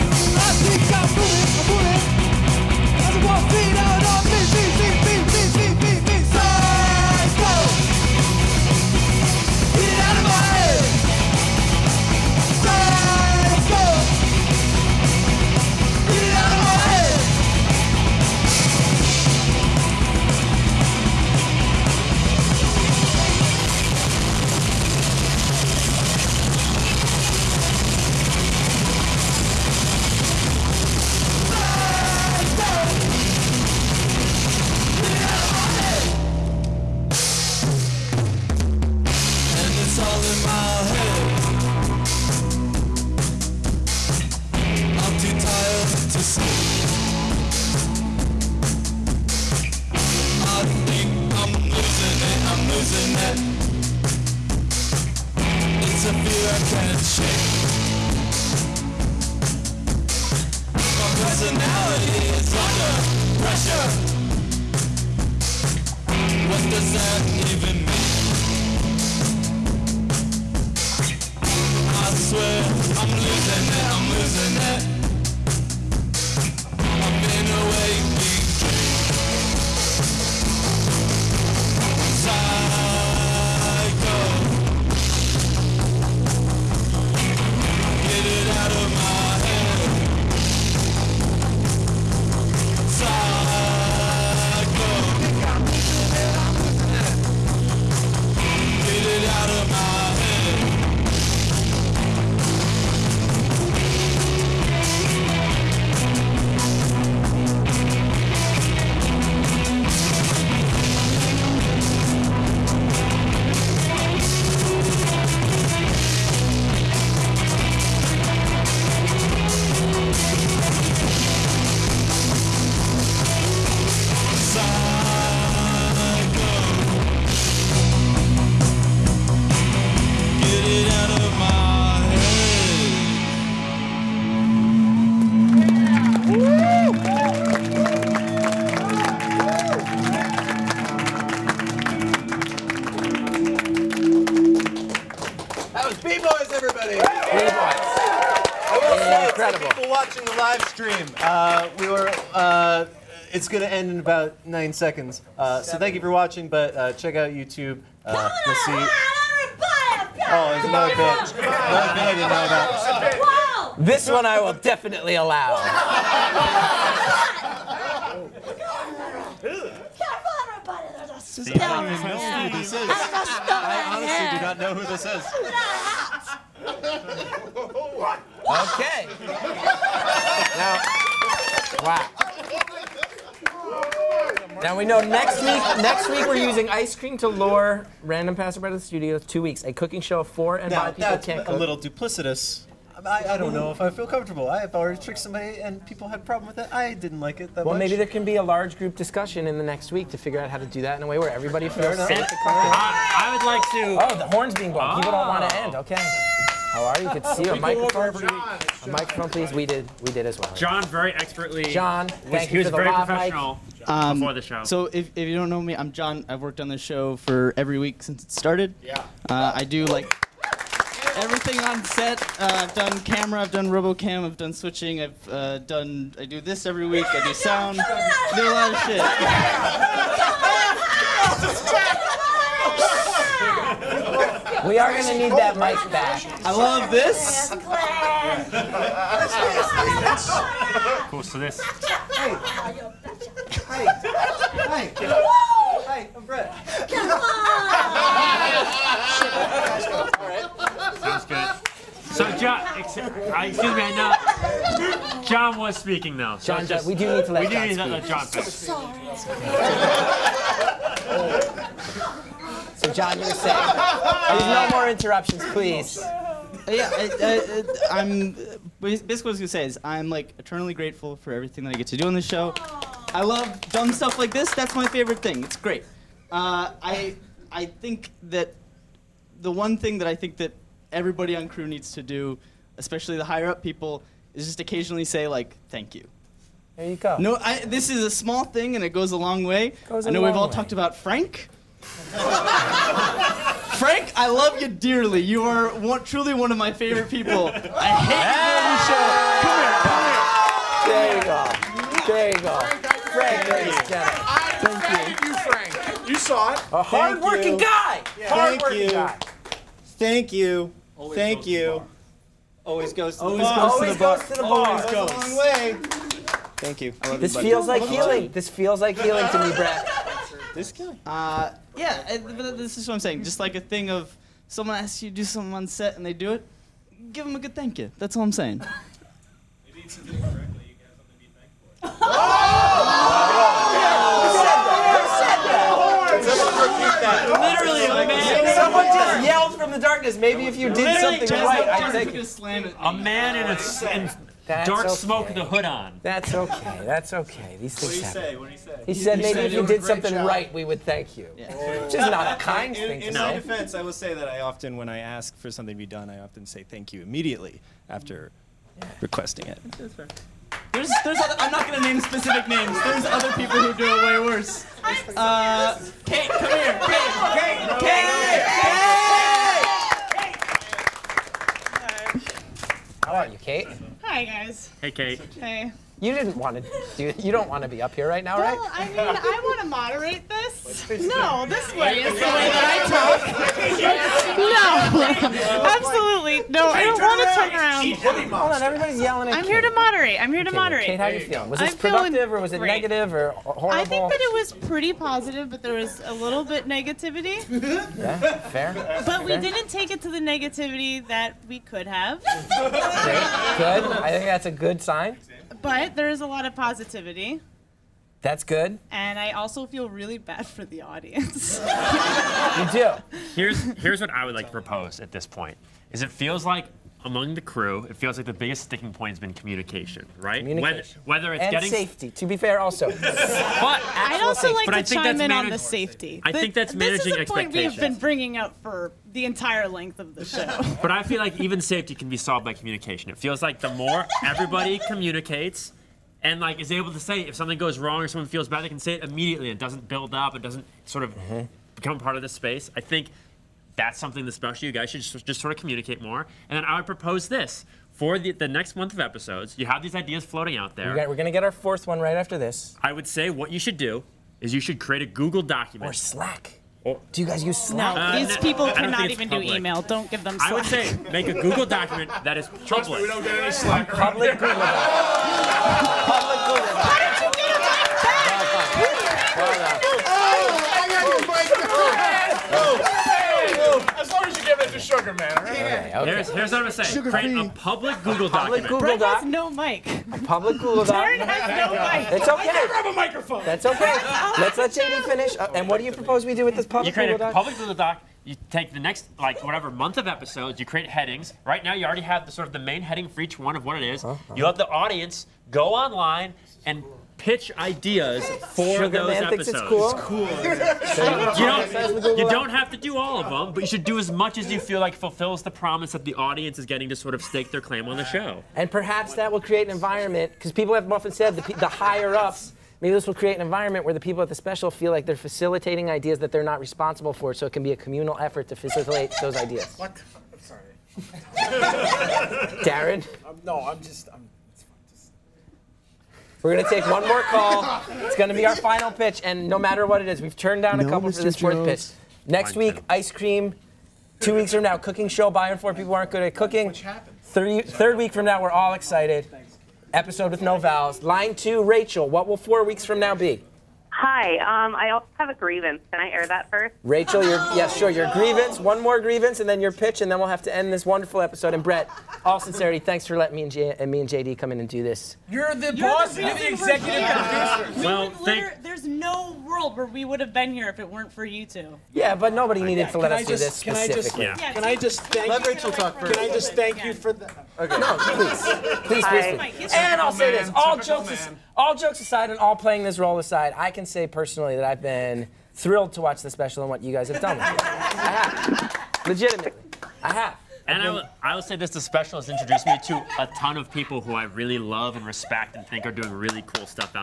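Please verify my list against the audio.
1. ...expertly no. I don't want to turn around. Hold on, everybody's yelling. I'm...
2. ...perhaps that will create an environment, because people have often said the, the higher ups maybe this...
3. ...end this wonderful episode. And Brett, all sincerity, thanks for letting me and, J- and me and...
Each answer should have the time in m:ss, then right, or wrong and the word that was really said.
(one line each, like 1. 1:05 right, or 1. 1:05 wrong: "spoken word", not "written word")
1. 6:25 wrong: "absolutely", not "expertly"
2. 8:28 right
3. 9:10 right.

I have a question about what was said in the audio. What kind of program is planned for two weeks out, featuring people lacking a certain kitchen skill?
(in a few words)
A cooking show.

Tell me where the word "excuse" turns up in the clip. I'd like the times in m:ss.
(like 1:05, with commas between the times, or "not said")
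4:12.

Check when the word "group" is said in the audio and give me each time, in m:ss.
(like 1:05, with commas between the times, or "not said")
3:18.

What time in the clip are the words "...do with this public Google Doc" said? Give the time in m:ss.
8:06.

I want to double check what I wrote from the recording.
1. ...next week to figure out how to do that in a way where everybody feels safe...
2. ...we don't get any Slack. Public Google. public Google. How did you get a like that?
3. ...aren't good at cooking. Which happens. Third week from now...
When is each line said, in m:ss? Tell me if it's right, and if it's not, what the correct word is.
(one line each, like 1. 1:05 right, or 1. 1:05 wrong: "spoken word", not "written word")
1. 3:19 right
2. 7:43 right
3. 8:55 right.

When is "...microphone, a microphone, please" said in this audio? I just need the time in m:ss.
3:27.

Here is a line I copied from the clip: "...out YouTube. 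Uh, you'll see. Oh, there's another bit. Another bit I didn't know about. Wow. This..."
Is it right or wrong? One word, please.
right.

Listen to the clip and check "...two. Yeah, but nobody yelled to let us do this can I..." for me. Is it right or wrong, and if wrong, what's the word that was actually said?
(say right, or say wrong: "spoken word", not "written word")
wrong: "needed", not "yelled".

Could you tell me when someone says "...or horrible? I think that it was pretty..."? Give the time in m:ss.
6:33.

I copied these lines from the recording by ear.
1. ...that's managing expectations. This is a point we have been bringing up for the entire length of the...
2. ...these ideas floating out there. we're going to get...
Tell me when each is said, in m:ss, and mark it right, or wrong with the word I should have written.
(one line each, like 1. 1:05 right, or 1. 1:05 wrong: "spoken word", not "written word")
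1. 7:06 right
2. 7:29 right.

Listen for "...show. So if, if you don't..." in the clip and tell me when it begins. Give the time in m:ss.
3:34.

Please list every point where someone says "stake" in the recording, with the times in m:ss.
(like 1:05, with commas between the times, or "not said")
8:27.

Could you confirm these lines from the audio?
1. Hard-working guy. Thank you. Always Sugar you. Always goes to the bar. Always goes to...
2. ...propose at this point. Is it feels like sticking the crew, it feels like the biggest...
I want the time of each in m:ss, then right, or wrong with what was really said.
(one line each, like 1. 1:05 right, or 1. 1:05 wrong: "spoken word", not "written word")
1. 5:08 wrong: "Thank", not "Sugar"
2. 6:54 wrong: "among", not "sticking".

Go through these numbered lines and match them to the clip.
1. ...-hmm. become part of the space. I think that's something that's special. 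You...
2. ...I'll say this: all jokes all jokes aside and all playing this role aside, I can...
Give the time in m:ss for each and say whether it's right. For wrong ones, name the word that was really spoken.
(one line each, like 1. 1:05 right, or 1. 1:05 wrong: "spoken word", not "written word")
1. 7:21 right
2. 9:29 right.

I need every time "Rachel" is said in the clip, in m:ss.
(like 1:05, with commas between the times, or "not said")
9:01, 9:06, 9:25.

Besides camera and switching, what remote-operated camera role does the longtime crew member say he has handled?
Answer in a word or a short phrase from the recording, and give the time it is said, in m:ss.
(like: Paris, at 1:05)
RoboCam, at 3:43.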